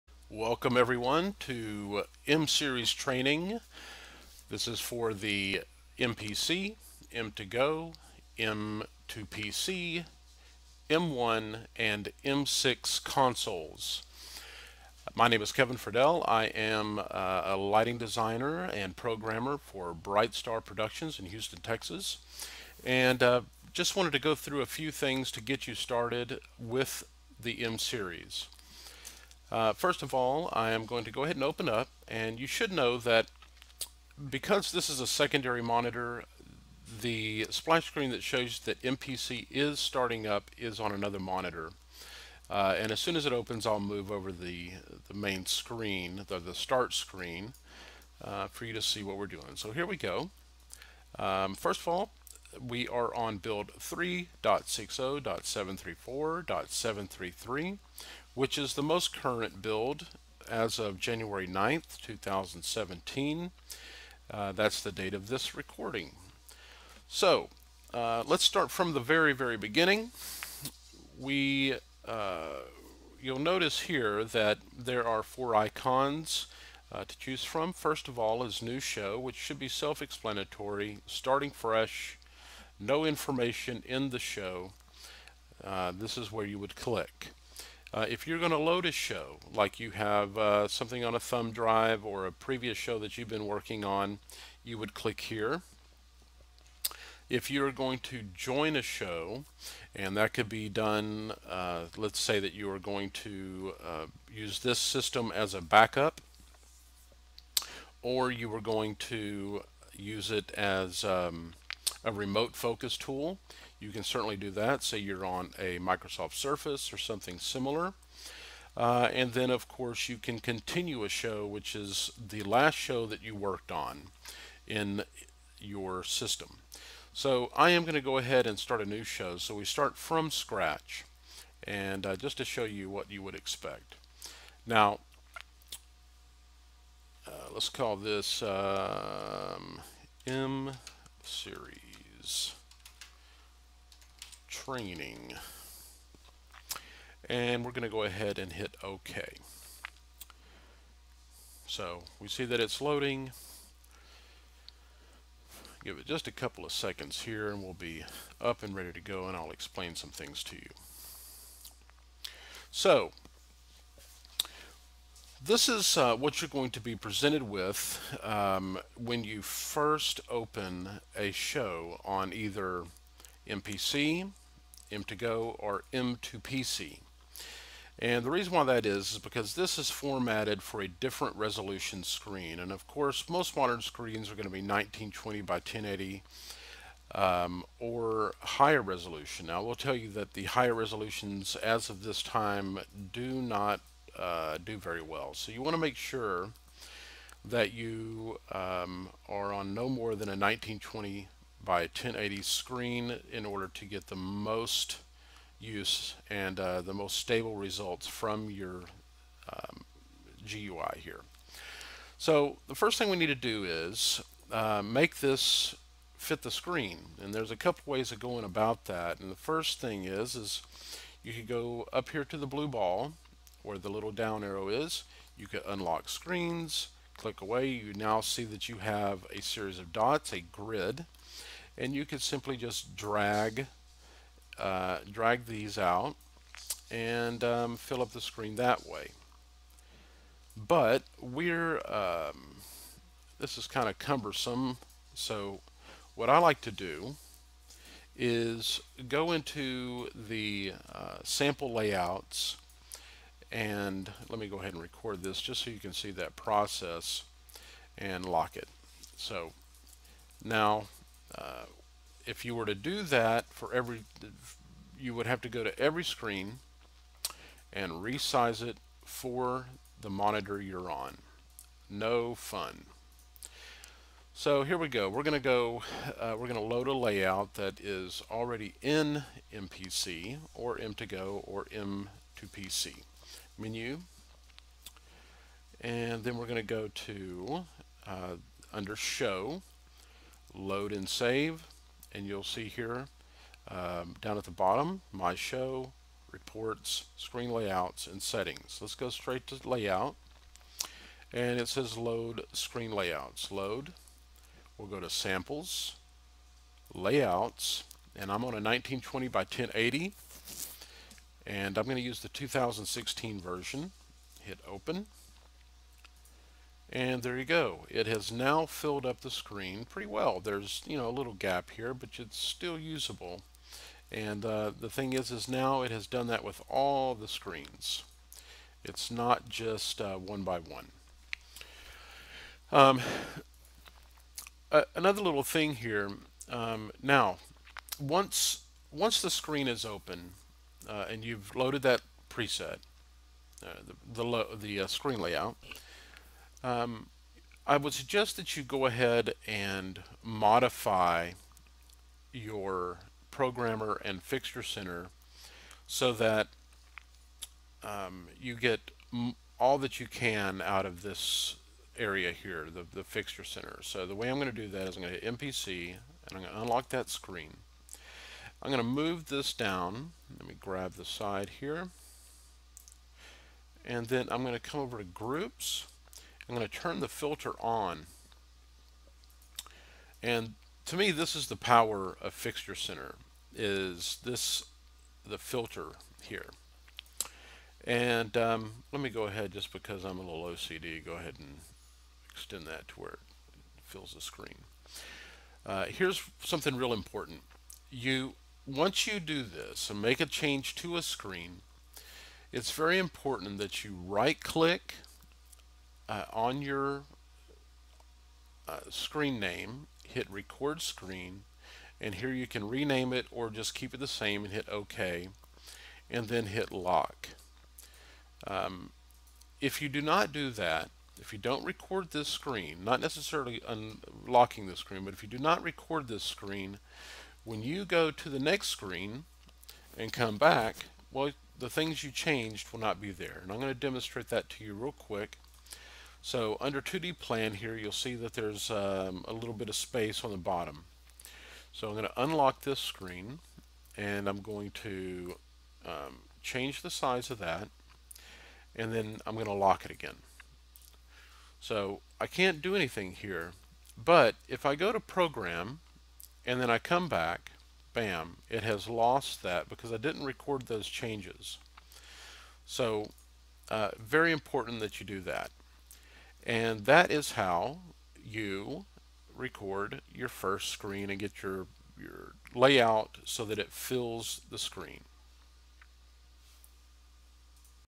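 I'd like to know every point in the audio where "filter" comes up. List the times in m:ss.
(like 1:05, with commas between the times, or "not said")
6:17, 6:25.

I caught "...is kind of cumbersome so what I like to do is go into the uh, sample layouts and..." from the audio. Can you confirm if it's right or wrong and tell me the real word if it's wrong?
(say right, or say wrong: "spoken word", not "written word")
right.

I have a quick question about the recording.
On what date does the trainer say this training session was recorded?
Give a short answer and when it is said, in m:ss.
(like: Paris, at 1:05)
January 9th, 2017, at 1:00.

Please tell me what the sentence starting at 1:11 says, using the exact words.
We, uh, you'll notice here that there are four icons uh, to choose from.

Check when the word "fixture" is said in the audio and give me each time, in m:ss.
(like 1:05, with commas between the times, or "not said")
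5:54, 6:03, 6:22.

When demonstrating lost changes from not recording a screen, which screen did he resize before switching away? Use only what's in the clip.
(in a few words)
2D plan.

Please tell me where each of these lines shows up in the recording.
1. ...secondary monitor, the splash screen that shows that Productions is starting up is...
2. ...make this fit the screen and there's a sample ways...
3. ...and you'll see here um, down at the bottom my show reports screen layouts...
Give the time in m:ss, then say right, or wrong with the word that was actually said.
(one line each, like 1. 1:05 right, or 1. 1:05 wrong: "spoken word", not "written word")
1. 0:35 wrong: "MPC", not "Productions"
2. 3:34 wrong: "couple", not "sample"
3. 4:52 right.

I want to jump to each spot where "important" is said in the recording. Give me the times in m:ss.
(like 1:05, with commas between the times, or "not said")
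6:36, 6:42, 7:44.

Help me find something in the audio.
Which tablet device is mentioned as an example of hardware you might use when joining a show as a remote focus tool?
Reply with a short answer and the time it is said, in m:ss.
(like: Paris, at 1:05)
Microsoft Surface, at 1:55.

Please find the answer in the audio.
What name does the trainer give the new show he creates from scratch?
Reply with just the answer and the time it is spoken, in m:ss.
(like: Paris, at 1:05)
M series training, at 2:20.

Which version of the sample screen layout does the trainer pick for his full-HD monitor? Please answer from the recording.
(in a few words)
2016 version.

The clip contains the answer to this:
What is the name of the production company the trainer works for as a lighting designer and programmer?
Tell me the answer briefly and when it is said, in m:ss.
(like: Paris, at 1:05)
Bright Star Productions, at 0:19.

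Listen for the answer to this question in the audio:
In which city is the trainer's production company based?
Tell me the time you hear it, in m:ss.
0:21.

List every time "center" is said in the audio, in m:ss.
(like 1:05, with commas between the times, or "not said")
5:54, 6:03, 6:22.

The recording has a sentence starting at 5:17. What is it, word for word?
It has now filled up the screen pretty well.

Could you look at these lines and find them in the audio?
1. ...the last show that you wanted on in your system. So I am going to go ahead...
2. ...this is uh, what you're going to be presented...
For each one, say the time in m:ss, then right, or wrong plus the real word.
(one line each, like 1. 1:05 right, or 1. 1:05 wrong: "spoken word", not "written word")
1. 2:02 wrong: "worked", not "wanted"
2. 2:45 right.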